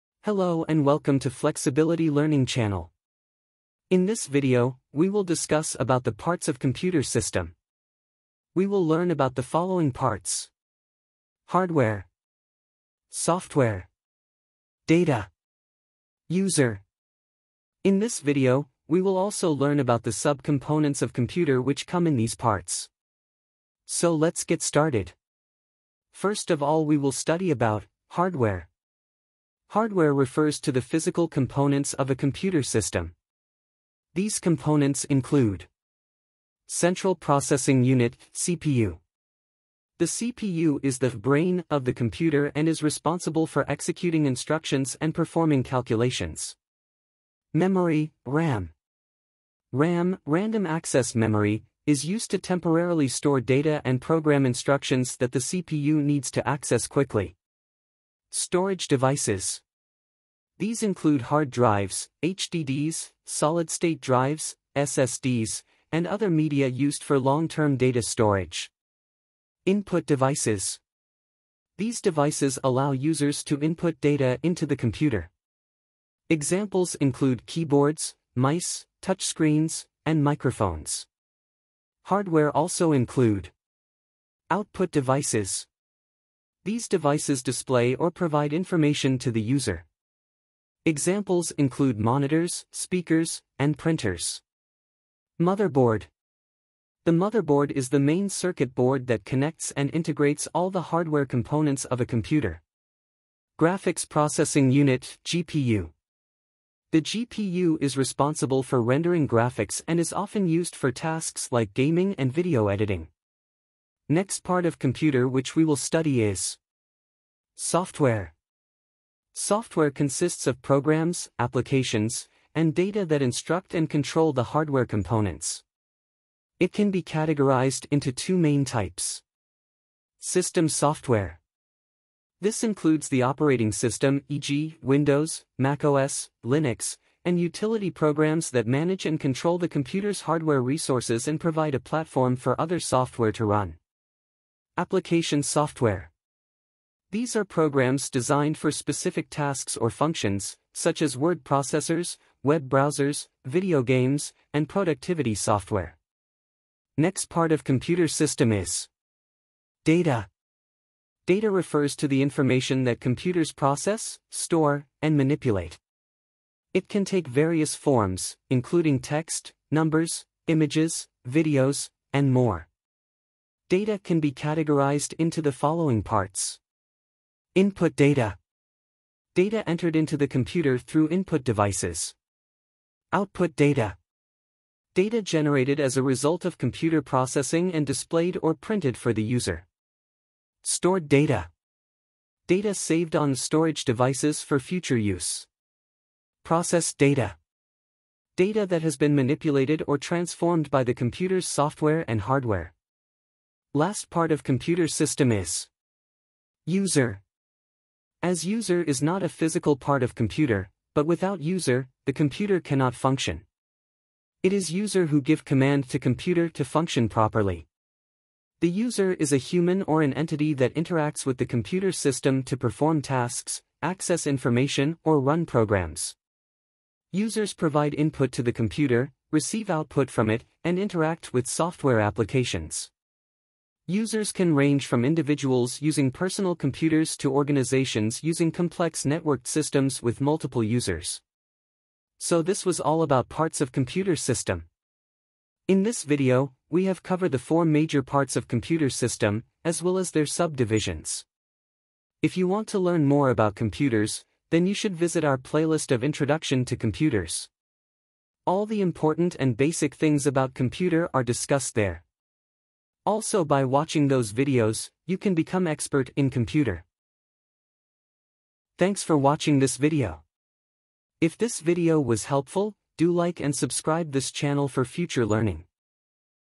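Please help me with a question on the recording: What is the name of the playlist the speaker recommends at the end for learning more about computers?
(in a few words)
Introduction to Computers.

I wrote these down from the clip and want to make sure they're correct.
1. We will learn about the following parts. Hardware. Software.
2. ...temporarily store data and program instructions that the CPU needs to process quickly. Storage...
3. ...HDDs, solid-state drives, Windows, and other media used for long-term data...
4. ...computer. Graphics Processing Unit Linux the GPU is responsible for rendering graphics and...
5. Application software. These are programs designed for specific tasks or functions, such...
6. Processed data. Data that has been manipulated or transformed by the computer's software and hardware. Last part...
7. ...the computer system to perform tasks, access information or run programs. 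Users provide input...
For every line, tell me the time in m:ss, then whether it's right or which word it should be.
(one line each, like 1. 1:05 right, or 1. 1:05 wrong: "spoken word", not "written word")
1. 0:08 right
2. 0:52 wrong: "access", not "process"
3. 1:02 wrong: "SSDs", not "Windows"
4. 1:42 wrong: "GPU", not "Linux"
5. 2:24 right
6. 3:16 right
7. 3:41 right.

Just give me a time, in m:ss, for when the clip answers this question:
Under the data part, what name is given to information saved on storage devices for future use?
3:10.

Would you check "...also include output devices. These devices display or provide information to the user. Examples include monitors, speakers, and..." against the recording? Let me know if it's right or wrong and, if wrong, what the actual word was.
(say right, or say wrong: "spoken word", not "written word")
right.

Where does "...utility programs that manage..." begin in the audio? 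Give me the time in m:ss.
2:17.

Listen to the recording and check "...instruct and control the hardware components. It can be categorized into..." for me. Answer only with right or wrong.
right.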